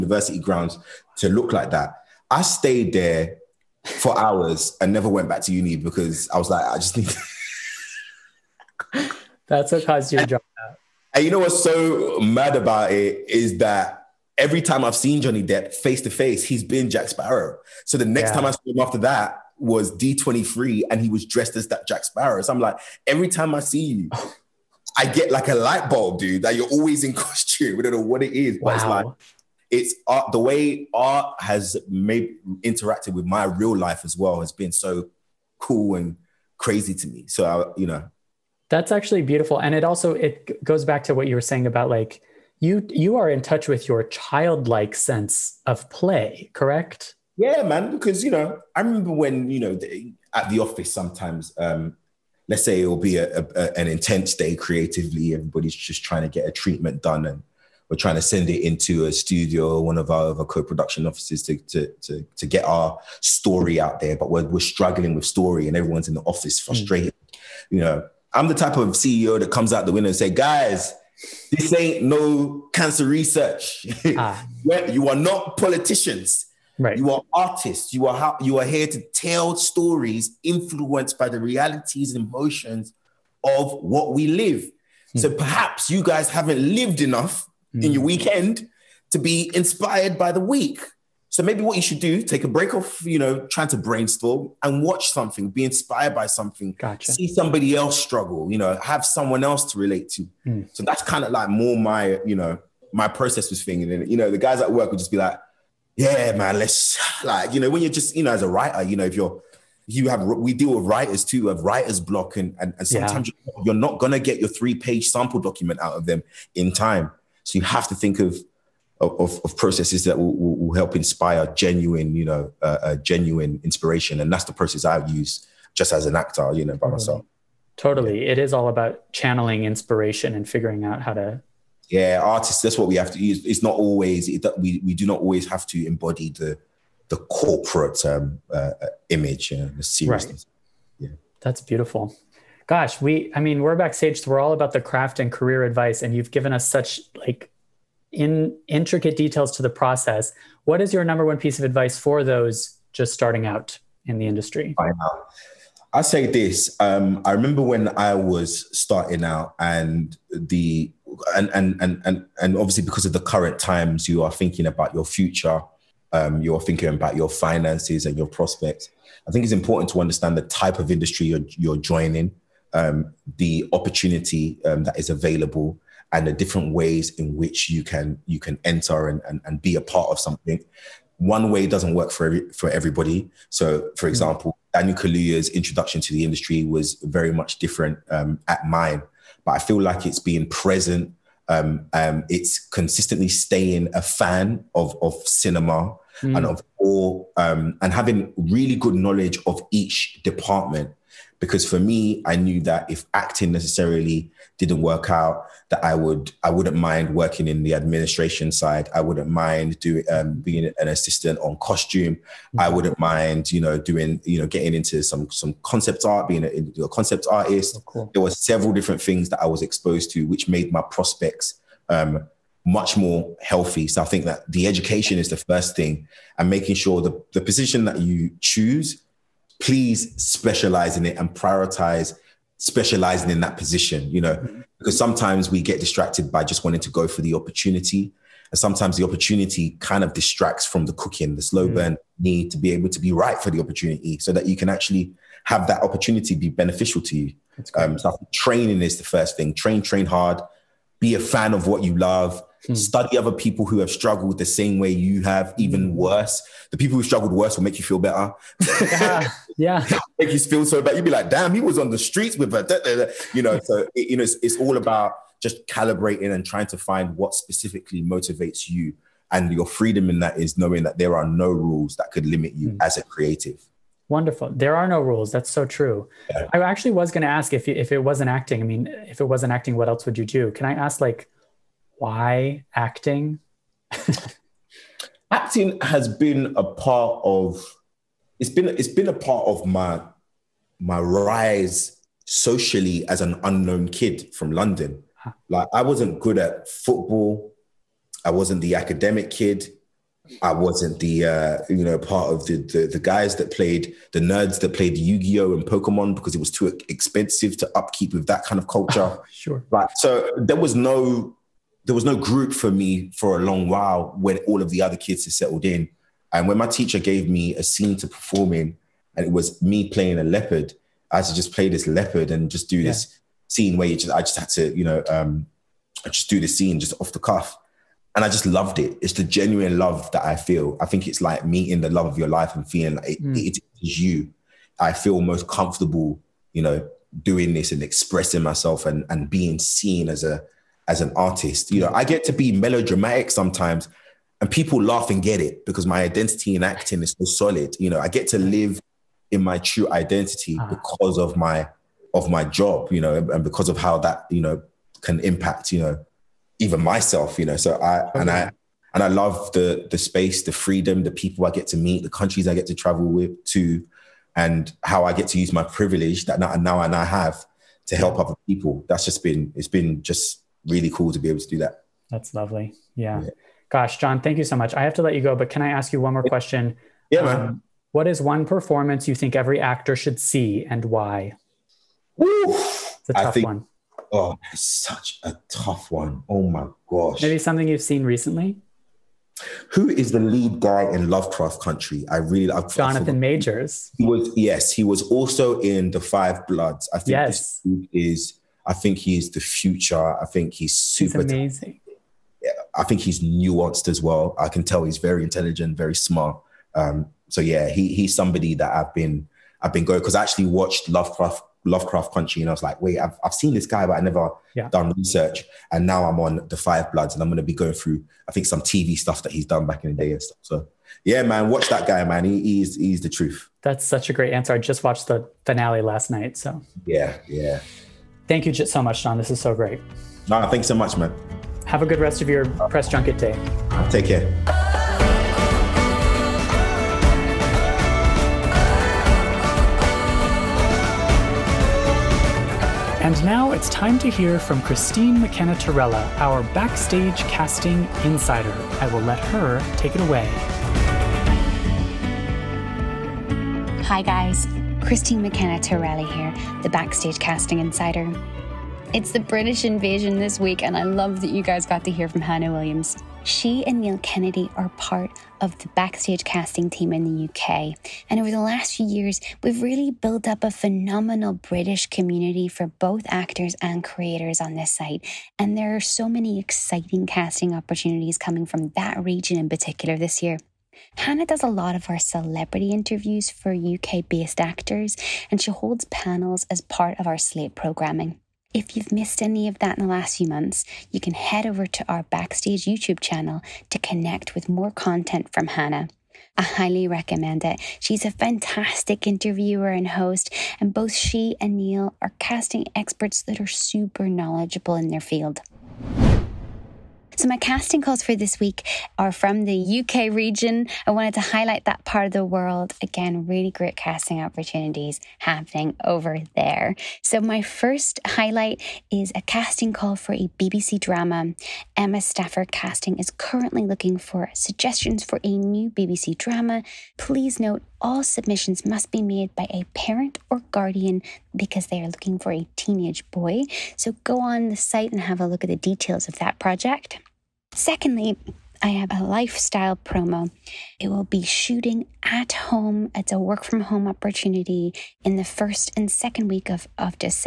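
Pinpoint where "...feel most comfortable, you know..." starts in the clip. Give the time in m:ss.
5:34.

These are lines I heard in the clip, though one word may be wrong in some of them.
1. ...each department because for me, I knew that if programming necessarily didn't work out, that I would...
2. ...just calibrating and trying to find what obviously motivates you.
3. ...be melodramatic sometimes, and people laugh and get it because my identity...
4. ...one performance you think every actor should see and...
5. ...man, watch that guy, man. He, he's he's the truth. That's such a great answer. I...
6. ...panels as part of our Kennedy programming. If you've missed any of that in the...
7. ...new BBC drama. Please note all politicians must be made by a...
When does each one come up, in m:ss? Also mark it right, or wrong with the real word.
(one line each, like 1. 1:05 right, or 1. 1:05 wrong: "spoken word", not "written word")
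1. 3:19 wrong: "acting", not "programming"
2. 4:25 wrong: "specifically", not "obviously"
3. 5:42 right
4. 6:18 right
5. 7:01 right
6. 8:05 wrong: "Slate", not "Kennedy"
7. 8:45 wrong: "submissions", not "politicians".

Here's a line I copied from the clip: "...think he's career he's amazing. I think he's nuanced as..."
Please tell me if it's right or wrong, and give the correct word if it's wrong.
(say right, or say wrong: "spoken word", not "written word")
wrong: "super", not "career".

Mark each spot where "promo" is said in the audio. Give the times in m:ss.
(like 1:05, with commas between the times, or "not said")
8:59.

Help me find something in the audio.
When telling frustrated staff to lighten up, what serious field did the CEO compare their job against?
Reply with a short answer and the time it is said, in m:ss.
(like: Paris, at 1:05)
cancer research, at 1:12.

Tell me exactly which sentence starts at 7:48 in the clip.
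And over the last few years, we've really built up a phenomenal British community for both actors and creators on this site.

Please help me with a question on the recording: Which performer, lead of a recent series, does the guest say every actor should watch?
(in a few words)
Jonathan Majors.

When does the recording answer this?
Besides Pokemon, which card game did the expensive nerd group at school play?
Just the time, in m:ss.
5:04.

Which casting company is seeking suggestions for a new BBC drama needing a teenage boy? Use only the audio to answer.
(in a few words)
Emma Stafford Casting.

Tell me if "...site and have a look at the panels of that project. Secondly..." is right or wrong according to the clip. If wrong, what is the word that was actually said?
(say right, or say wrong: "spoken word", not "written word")
wrong: "details", not "panels".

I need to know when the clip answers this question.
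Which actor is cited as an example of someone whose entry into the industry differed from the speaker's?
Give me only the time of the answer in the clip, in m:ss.
3:04.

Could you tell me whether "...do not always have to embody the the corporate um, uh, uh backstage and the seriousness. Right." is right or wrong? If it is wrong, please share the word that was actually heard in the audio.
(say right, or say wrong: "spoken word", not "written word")
wrong: "image", not "backstage".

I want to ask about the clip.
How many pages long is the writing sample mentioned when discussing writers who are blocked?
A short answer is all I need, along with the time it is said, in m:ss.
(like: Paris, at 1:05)
3, at 1:54.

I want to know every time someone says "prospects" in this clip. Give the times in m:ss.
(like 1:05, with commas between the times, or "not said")
2:48, 3:40.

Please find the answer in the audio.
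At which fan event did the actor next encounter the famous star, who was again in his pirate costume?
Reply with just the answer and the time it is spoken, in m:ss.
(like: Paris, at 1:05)
D23, at 0:19.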